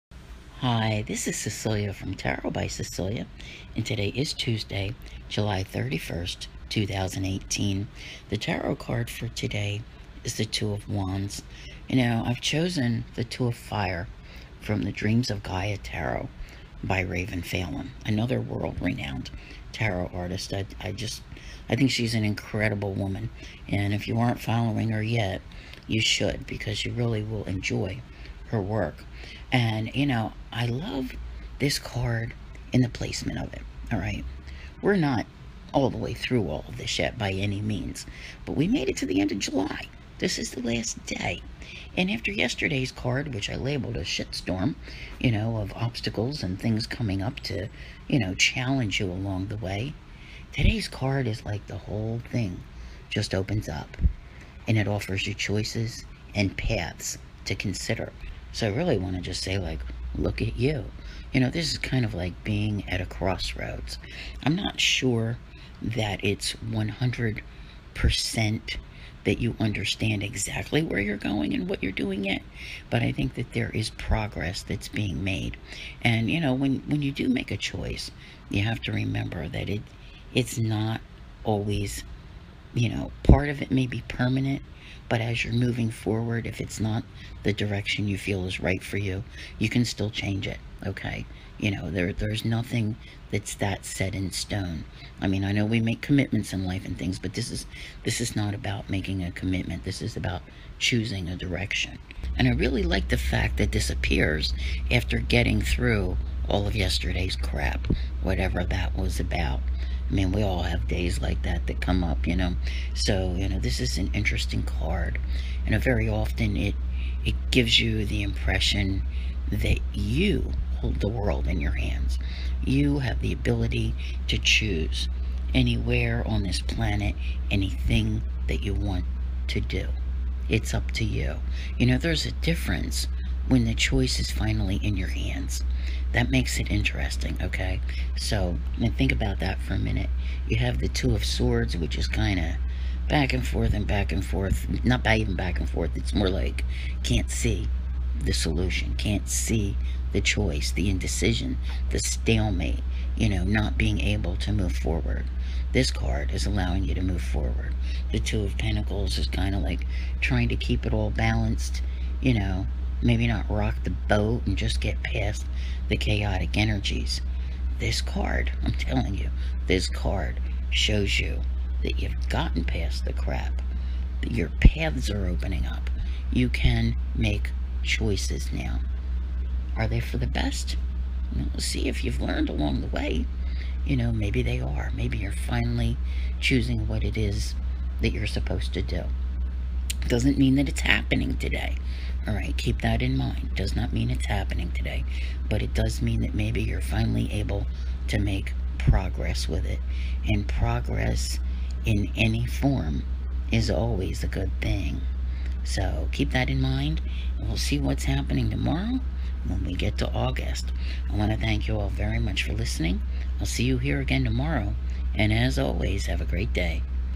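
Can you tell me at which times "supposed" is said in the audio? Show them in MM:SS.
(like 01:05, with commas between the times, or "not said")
03:08.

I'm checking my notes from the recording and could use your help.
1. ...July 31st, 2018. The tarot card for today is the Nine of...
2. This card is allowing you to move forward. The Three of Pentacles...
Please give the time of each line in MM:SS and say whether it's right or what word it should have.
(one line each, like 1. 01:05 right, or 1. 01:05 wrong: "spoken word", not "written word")
1. 00:05 wrong: "Two", not "Nine"
2. 02:35 wrong: "Two", not "Three".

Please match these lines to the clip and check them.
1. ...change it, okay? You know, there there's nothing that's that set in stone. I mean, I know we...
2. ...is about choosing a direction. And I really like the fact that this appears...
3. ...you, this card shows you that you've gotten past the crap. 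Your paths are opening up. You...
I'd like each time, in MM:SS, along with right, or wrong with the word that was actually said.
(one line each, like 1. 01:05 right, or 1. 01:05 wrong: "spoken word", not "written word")
1. 01:30 right
2. 01:40 right
3. 02:49 right.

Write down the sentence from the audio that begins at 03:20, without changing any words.
And progress in any form is always a good thing.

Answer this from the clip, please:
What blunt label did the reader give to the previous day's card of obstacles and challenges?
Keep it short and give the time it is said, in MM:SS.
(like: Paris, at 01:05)
shitstorm, at 00:44.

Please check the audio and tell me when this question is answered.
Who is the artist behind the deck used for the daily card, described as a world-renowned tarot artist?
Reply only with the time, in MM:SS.
00:17.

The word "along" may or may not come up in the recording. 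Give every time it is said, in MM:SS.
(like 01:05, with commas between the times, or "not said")
00:49, 03:02.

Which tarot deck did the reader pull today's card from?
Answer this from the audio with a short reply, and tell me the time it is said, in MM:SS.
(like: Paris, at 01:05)
Dreams of Gaia Tarot, at 00:14.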